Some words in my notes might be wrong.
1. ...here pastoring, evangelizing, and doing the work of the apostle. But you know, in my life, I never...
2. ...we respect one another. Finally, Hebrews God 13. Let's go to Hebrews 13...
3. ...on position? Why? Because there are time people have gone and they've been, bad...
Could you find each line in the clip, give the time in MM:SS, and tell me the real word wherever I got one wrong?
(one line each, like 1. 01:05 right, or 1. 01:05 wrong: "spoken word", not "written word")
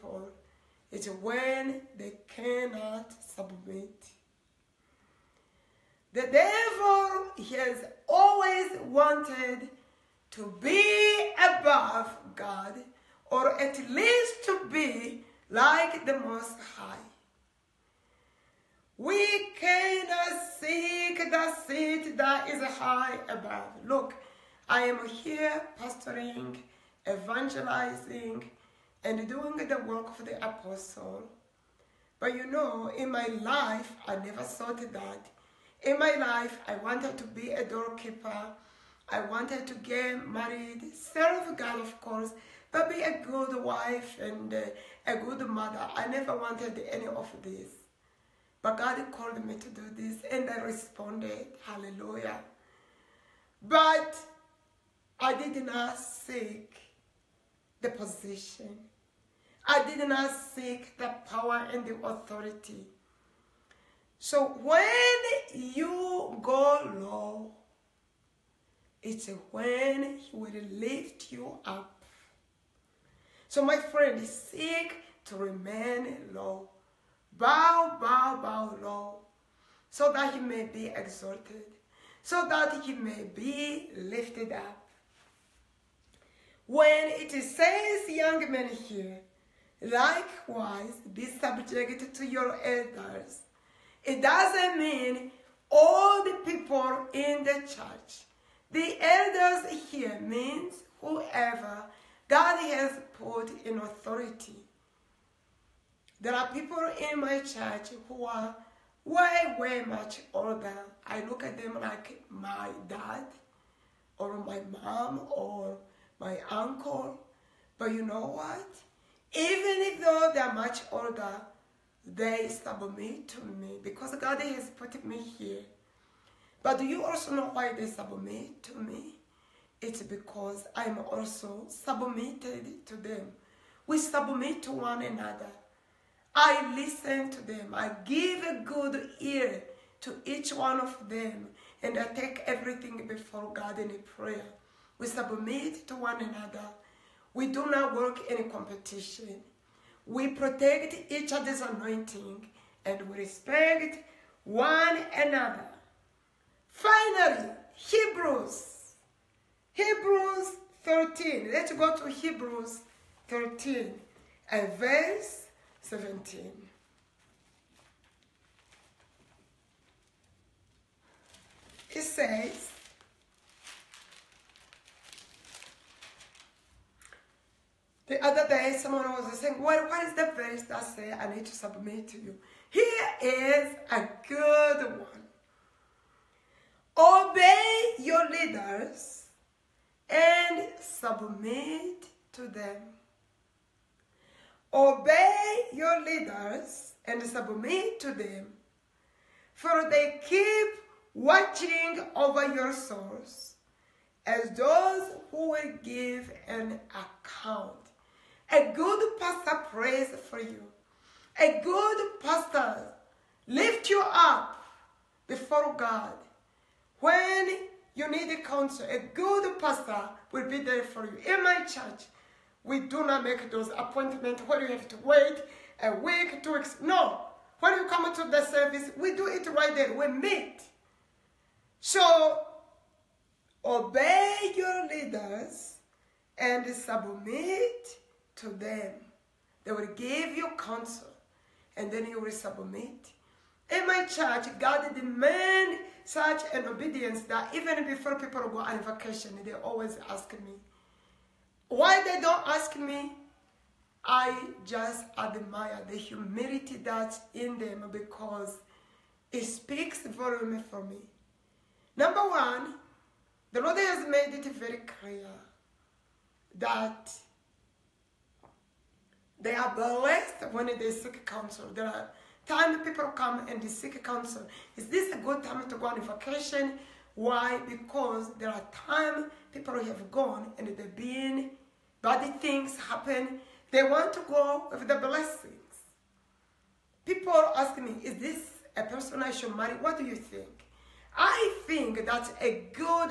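1. 00:25 right
2. 02:33 wrong: "Hebrews", not "God"
3. 04:35 wrong: "vacation", not "position".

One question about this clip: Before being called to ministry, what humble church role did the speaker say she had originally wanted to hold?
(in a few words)
Doorkeeper.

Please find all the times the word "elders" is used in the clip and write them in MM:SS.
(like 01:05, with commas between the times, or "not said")
01:32, 01:38.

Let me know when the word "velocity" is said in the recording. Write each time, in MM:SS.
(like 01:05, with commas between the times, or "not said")
not said.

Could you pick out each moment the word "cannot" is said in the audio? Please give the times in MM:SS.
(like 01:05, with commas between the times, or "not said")
00:02, 00:19.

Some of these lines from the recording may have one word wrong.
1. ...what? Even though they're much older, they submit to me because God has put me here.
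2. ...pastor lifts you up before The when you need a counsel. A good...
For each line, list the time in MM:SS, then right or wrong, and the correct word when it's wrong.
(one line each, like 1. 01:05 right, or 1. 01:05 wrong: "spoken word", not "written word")
1. 01:58 right
2. 03:32 wrong: "God", not "The".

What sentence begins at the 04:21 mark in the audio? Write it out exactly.
Number one, the Lord has made it very clear that they are blessed when they seek counsel.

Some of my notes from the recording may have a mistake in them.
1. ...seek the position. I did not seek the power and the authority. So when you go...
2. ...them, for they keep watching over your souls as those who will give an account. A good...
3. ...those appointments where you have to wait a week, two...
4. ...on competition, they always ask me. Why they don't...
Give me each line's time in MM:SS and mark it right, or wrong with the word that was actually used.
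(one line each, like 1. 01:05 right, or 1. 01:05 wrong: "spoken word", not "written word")
1. 00:55 right
2. 03:18 right
3. 03:43 right
4. 04:08 wrong: "vacation", not "competition".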